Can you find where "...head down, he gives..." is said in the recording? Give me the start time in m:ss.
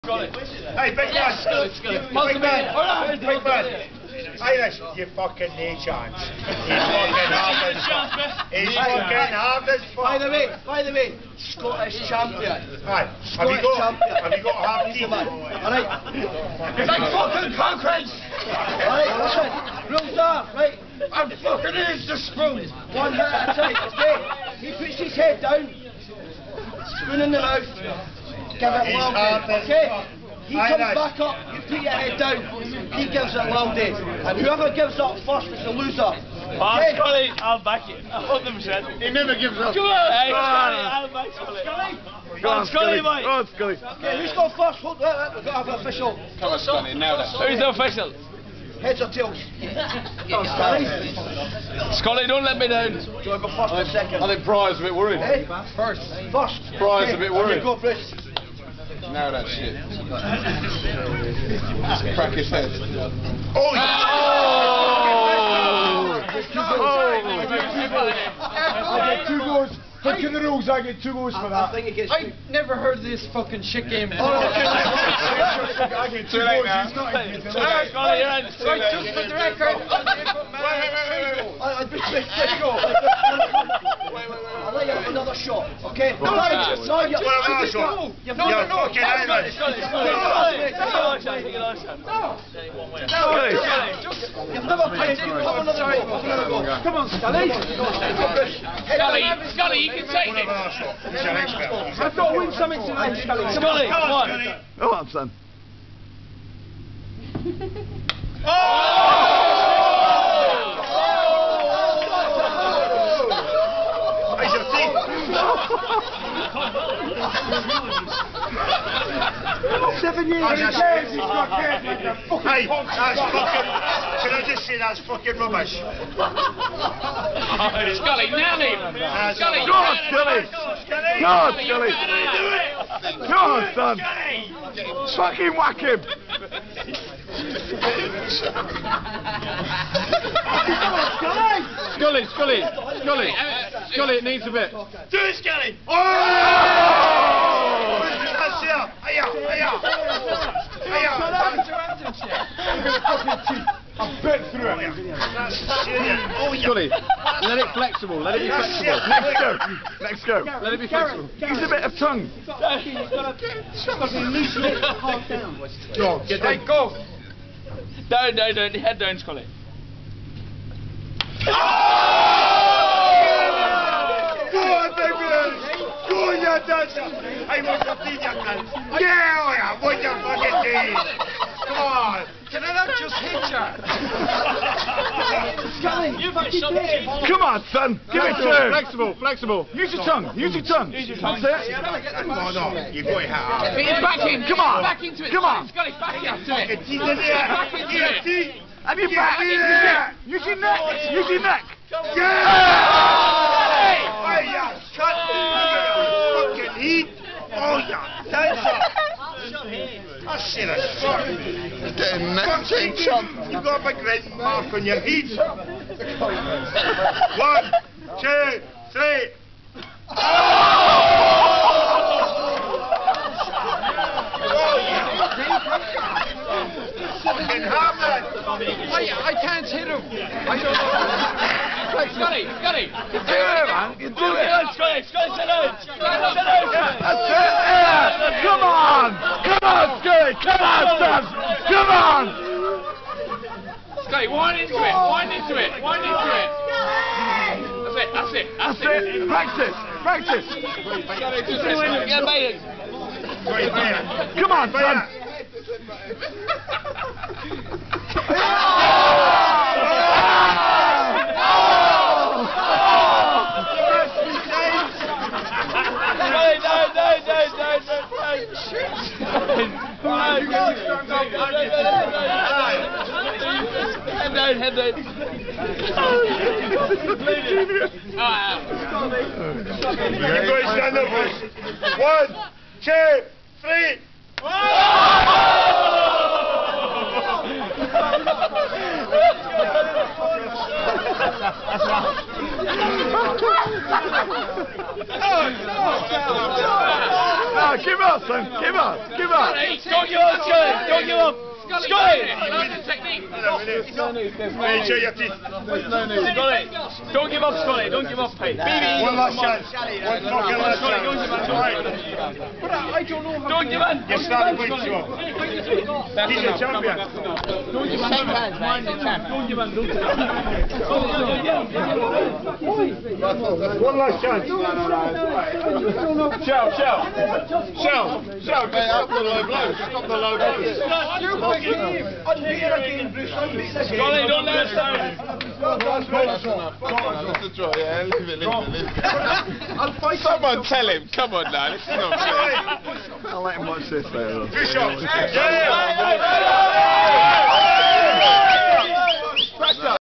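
0:31.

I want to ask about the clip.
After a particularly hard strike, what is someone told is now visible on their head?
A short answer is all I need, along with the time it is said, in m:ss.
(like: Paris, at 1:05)
A big red mark, at 3:33.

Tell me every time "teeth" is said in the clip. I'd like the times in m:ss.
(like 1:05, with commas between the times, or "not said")
3:00.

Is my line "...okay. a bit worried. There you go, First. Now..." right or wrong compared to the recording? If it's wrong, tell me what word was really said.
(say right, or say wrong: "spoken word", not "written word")
wrong: "Bruce", not "First".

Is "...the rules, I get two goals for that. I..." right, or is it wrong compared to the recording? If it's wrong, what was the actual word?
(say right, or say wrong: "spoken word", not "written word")
right.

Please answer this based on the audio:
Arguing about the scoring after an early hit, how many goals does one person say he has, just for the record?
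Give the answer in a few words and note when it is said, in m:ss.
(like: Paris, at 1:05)
3 goals, at 1:21.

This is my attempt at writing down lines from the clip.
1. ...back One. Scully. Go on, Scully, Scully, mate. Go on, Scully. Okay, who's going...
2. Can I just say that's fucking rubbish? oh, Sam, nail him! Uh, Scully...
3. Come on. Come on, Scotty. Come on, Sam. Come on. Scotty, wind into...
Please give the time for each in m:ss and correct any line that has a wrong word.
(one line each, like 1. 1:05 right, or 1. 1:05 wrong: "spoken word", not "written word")
1. 0:41 wrong: "Scully", not "One"
2. 2:04 wrong: "Scully", not "Sam"
3. 3:58 right.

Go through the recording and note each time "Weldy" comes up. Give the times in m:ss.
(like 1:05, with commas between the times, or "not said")
0:28, 0:33.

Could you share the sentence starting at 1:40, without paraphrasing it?
I've got to win something tonight, Scully.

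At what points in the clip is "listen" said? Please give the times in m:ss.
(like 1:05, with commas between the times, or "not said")
0:19, 4:11.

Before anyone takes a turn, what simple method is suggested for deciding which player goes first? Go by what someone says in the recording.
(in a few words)
Heads or tails.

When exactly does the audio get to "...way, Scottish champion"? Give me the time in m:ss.
0:10.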